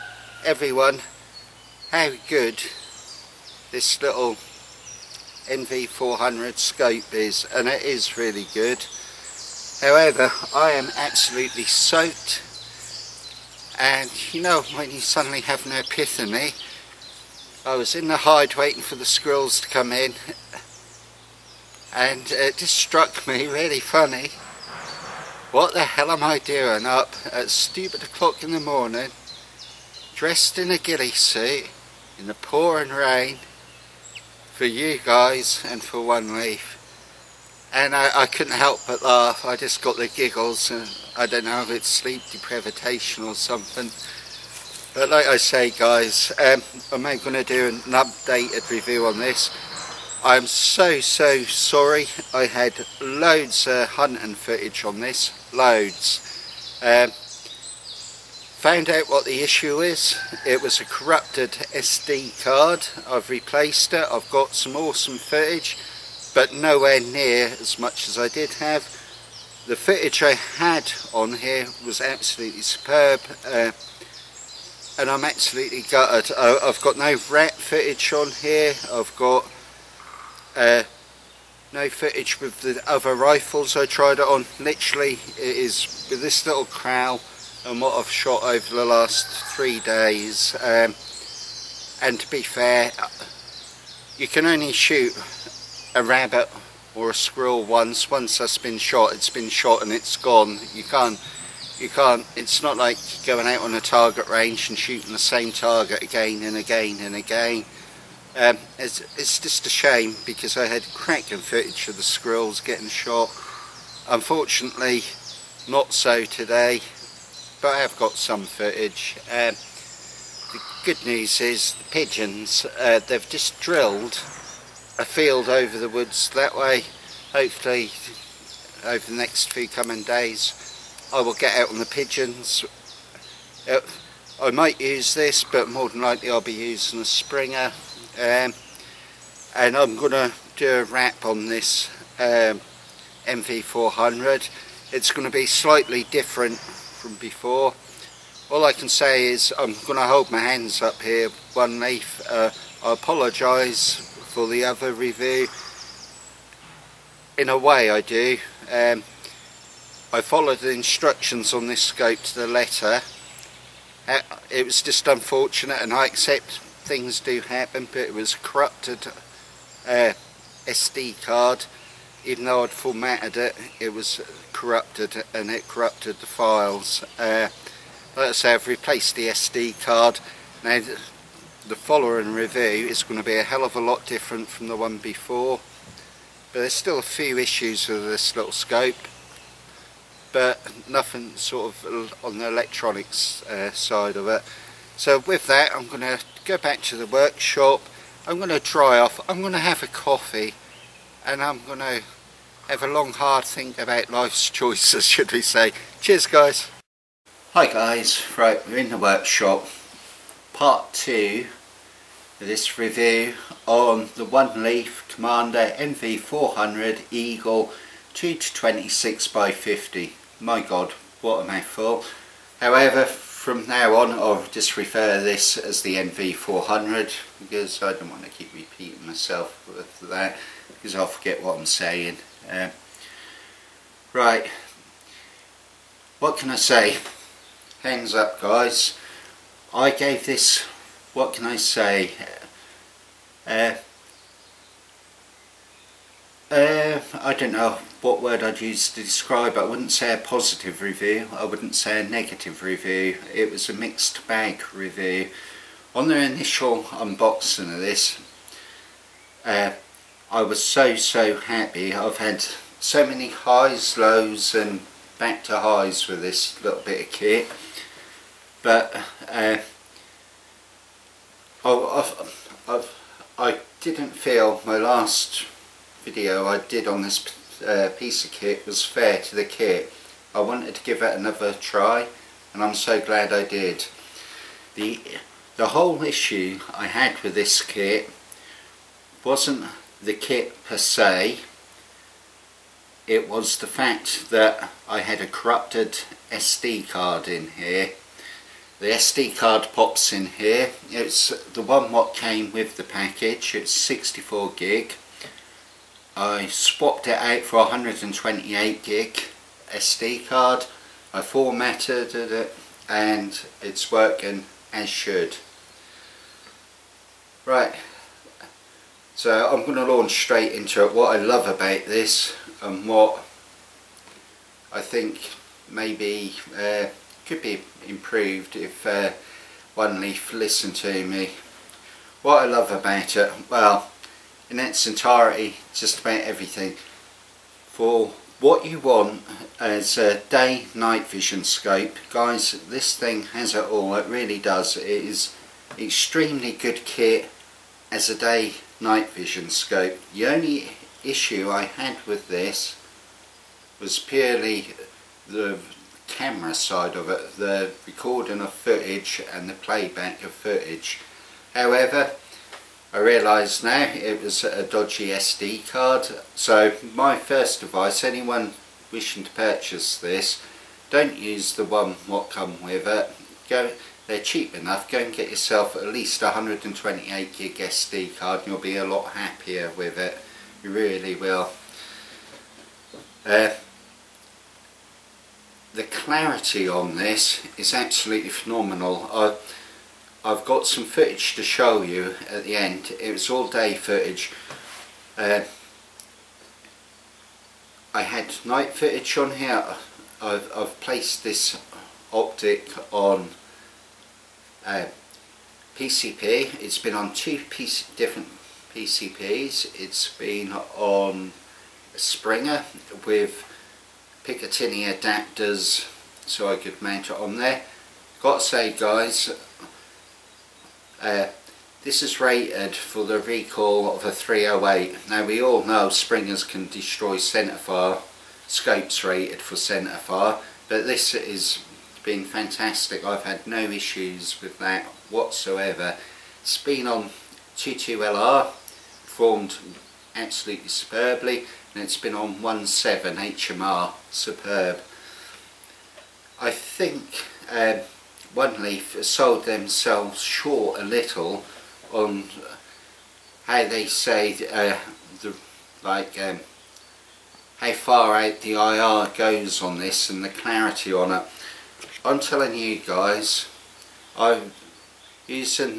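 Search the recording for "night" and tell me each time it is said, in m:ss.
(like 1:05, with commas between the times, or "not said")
5:40, 5:48, 6:38.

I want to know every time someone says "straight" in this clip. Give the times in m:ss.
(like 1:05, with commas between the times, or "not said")
5:20.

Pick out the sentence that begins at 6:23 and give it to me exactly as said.
Uh, the clarity on this is absolutely phenomenal.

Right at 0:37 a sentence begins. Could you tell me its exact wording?
And I, I couldn't help but laugh, I just got the giggles and I don't know if it's sleep deprivation or something.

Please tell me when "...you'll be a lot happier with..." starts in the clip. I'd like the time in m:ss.
6:18.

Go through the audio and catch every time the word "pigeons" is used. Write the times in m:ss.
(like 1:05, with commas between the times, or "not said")
2:01, 2:11.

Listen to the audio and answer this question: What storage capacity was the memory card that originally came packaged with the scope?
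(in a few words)
64 gig.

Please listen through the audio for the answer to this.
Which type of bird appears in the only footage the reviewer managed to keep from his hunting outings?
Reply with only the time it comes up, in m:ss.
1:26.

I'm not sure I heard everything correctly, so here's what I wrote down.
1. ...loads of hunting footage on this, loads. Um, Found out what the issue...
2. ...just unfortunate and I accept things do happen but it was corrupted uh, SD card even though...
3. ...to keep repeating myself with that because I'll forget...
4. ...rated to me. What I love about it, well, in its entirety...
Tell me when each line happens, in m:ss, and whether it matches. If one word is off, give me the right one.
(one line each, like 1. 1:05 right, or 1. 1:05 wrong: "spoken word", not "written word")
1. 0:53 right
2. 2:44 right
3. 3:48 right
4. 5:30 wrong: "listened", not "rated".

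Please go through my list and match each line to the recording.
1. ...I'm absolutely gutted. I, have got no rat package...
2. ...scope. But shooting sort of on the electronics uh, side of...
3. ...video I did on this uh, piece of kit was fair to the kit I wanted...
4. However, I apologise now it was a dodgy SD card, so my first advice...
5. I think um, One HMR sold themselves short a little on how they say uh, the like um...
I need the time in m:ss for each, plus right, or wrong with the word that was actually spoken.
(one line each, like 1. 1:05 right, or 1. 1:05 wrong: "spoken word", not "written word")
1. 1:15 wrong: "footage", not "package"
2. 3:08 wrong: "nothing", not "shooting"
3. 4:36 right
4. 6:01 wrong: "realise", not "apologise"
5. 7:26 wrong: "Leaf", not "HMR".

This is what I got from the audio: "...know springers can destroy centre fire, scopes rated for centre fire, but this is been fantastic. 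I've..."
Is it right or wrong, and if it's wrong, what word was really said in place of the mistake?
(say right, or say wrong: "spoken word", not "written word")
right.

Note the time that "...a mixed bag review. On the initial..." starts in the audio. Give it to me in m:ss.
4:13.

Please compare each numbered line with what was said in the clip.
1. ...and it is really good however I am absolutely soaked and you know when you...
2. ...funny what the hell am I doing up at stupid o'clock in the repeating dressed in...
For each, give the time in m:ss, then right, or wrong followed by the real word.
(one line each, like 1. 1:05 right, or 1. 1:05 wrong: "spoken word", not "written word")
1. 0:07 right
2. 0:23 wrong: "morning", not "repeating".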